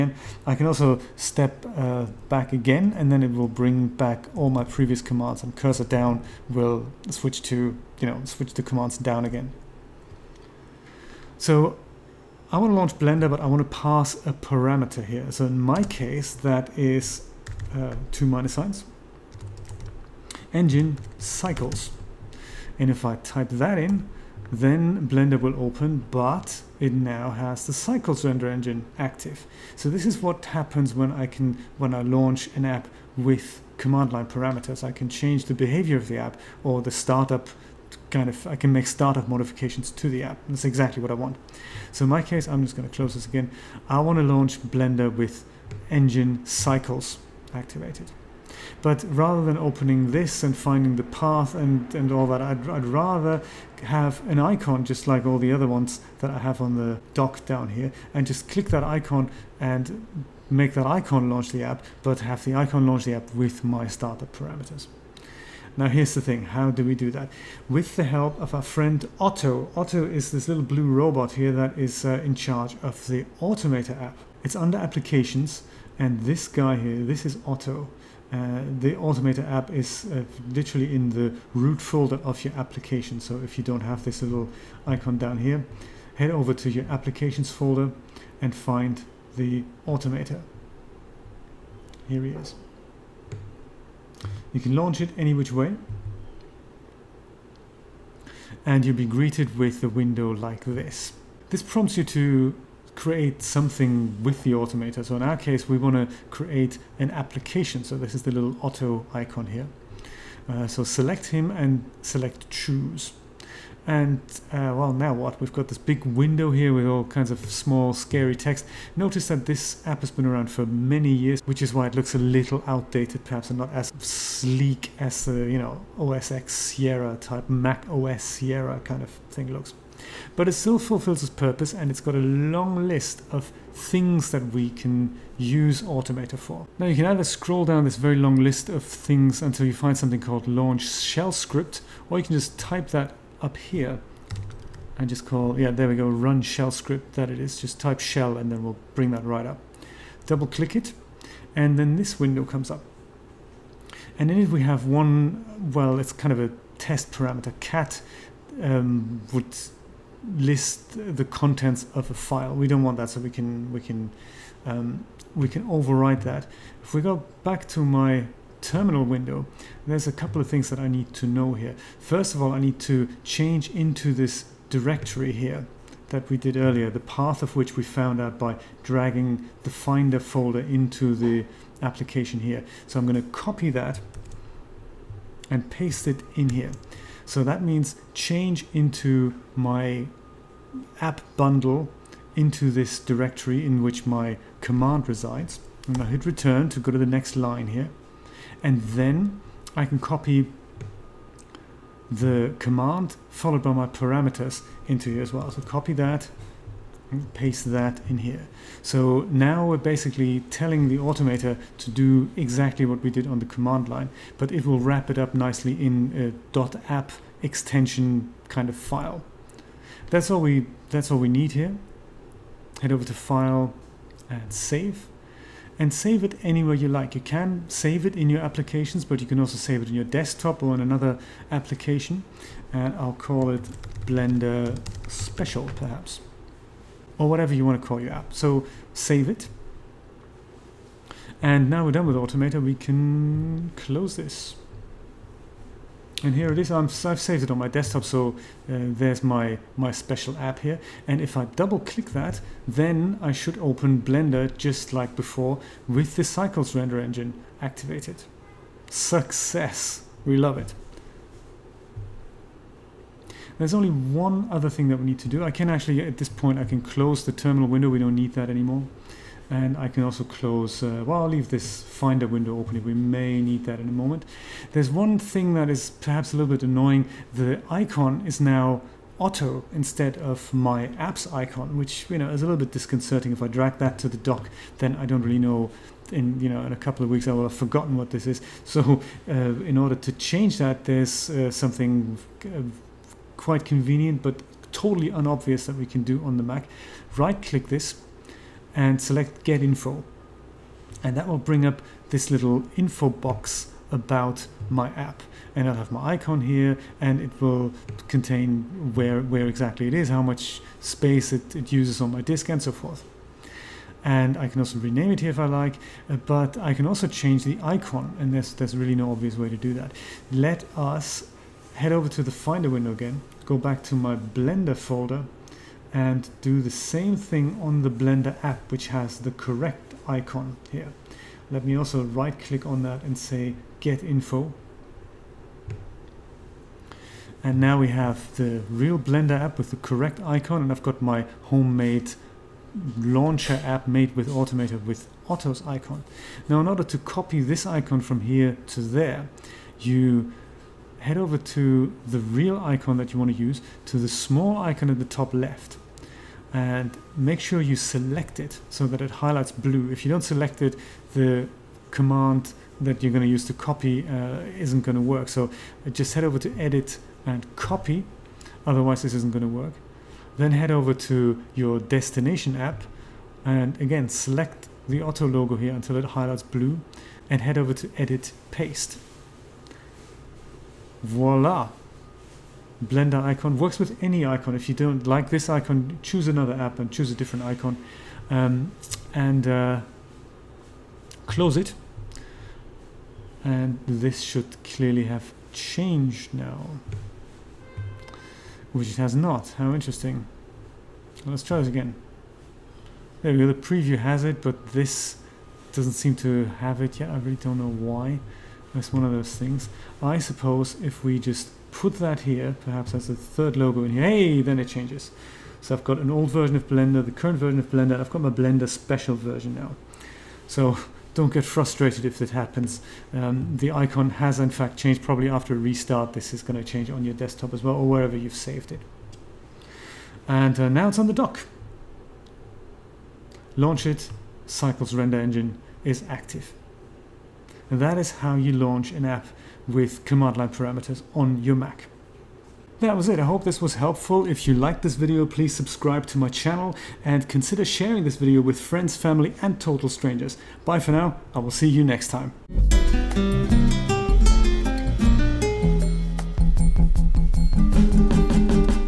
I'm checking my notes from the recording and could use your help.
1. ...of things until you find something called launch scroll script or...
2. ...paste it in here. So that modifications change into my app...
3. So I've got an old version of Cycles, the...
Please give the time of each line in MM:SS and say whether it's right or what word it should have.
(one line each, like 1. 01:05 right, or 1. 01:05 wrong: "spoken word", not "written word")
1. 02:18 wrong: "shell", not "scroll"
2. 03:05 wrong: "means", not "modifications"
3. 06:55 wrong: "Blender", not "Cycles".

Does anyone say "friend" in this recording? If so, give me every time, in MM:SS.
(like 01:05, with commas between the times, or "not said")
01:08, 07:28.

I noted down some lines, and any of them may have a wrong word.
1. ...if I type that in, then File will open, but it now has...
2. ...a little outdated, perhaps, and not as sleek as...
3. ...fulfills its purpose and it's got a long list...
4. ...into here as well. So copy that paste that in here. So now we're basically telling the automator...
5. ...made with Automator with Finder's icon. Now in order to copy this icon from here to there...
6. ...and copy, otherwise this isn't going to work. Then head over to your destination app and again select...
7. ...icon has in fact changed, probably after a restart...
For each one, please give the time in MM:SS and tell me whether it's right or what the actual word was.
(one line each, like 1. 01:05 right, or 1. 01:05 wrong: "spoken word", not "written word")
1. 00:22 wrong: "Blender", not "File"
2. 02:02 right
3. 02:10 right
4. 03:24 right
5. 05:43 wrong: "Otto", not "Finder"
6. 06:07 right
7. 07:03 right.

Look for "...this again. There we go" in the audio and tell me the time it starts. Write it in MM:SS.
06:41.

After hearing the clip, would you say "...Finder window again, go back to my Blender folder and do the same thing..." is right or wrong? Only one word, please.
right.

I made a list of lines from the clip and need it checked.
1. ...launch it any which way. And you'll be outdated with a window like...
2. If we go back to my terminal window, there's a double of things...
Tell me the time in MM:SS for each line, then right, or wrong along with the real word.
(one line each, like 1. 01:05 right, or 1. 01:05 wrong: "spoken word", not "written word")
1. 01:34 wrong: "greeted", not "outdated"
2. 02:46 wrong: "couple", not "double".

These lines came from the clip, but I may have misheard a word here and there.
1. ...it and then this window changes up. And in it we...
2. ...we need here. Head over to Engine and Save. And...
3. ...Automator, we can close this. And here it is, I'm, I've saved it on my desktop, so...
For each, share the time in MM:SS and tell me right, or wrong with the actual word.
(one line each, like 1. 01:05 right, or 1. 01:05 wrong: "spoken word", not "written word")
1. 02:30 wrong: "comes", not "changes"
2. 03:41 wrong: "File", not "Engine"
3. 04:02 right.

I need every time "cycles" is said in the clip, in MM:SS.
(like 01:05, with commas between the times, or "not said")
00:21, 00:27, 00:46, 04:16, 07:14.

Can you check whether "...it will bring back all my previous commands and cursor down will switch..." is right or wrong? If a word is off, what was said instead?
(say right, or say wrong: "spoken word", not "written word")
right.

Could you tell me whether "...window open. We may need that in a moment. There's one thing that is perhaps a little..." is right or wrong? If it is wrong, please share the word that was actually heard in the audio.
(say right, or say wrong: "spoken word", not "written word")
right.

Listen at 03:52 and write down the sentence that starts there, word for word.
And I'll call it Blender Special, perhaps or whatever you want to call your app.